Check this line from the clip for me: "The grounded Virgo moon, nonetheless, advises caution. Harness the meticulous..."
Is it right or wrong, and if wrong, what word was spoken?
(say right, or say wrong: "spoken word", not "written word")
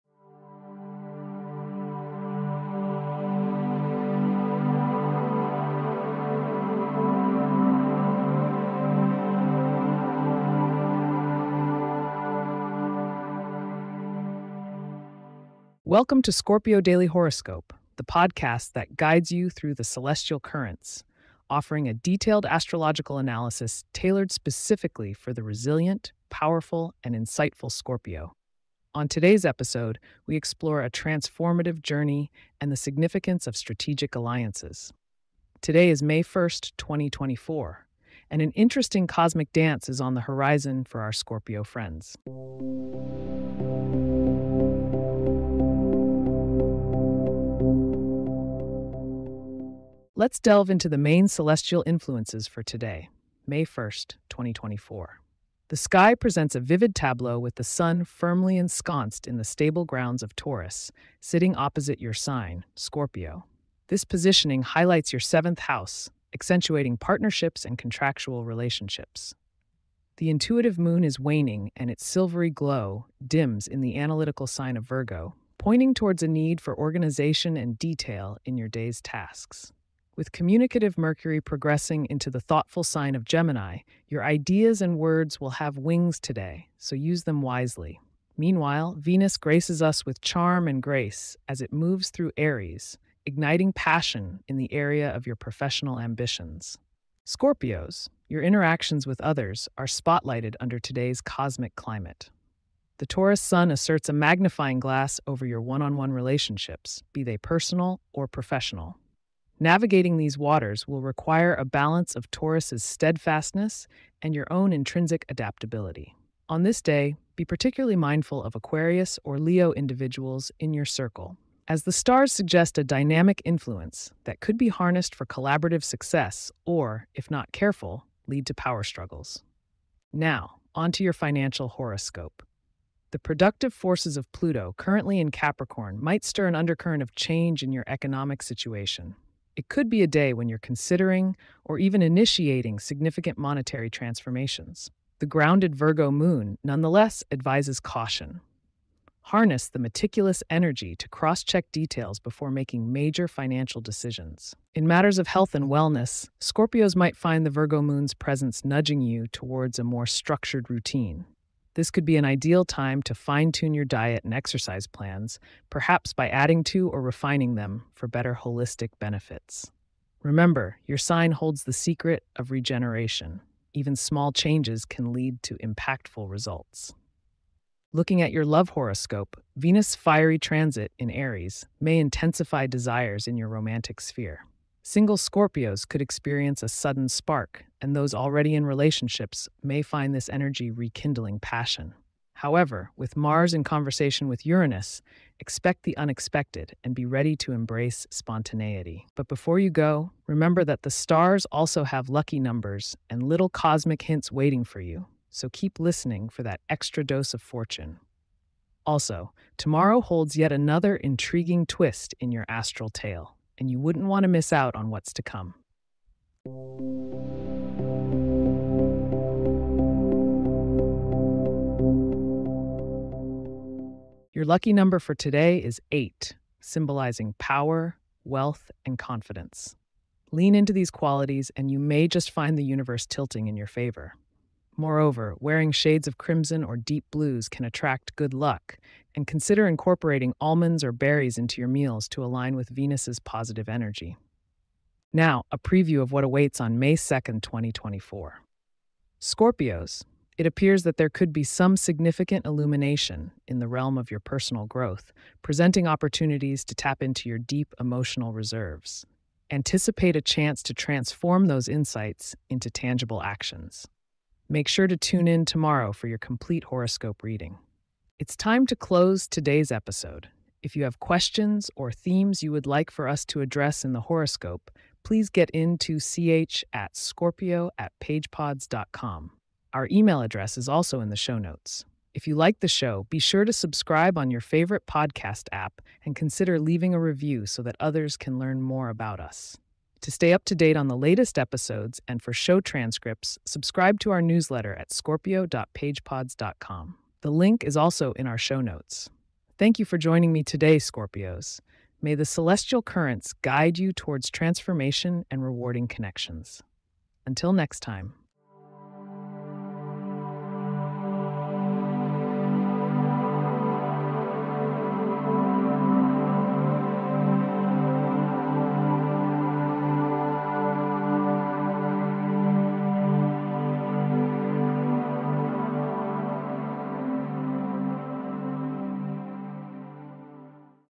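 right.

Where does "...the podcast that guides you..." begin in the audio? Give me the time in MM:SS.
00:17.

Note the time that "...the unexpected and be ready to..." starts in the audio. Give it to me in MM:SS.
03:15.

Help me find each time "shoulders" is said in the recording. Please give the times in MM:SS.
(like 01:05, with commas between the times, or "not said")
not said.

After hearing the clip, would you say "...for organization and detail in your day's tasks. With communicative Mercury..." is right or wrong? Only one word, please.
right.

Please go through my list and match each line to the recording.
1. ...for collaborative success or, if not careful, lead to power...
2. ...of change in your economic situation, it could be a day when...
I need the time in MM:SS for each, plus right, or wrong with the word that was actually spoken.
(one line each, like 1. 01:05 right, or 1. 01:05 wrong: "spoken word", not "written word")
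1. 02:05 right
2. 02:17 right.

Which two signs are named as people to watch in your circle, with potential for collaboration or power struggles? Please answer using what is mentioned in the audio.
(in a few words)
Aquarius or Leo.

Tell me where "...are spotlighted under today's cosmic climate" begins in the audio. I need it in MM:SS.
01:39.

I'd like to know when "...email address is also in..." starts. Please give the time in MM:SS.
04:39.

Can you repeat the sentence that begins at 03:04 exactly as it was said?
Single Scorpios could experience a sudden spark, and those already in relationships may find this energy rekindling passion.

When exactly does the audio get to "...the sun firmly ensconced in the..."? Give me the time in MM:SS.
00:57.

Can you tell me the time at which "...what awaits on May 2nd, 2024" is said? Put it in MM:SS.
04:06.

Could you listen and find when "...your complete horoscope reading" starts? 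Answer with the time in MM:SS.
04:26.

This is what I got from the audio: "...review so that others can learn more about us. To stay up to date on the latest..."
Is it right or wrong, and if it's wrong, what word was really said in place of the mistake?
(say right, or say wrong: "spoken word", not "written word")
right.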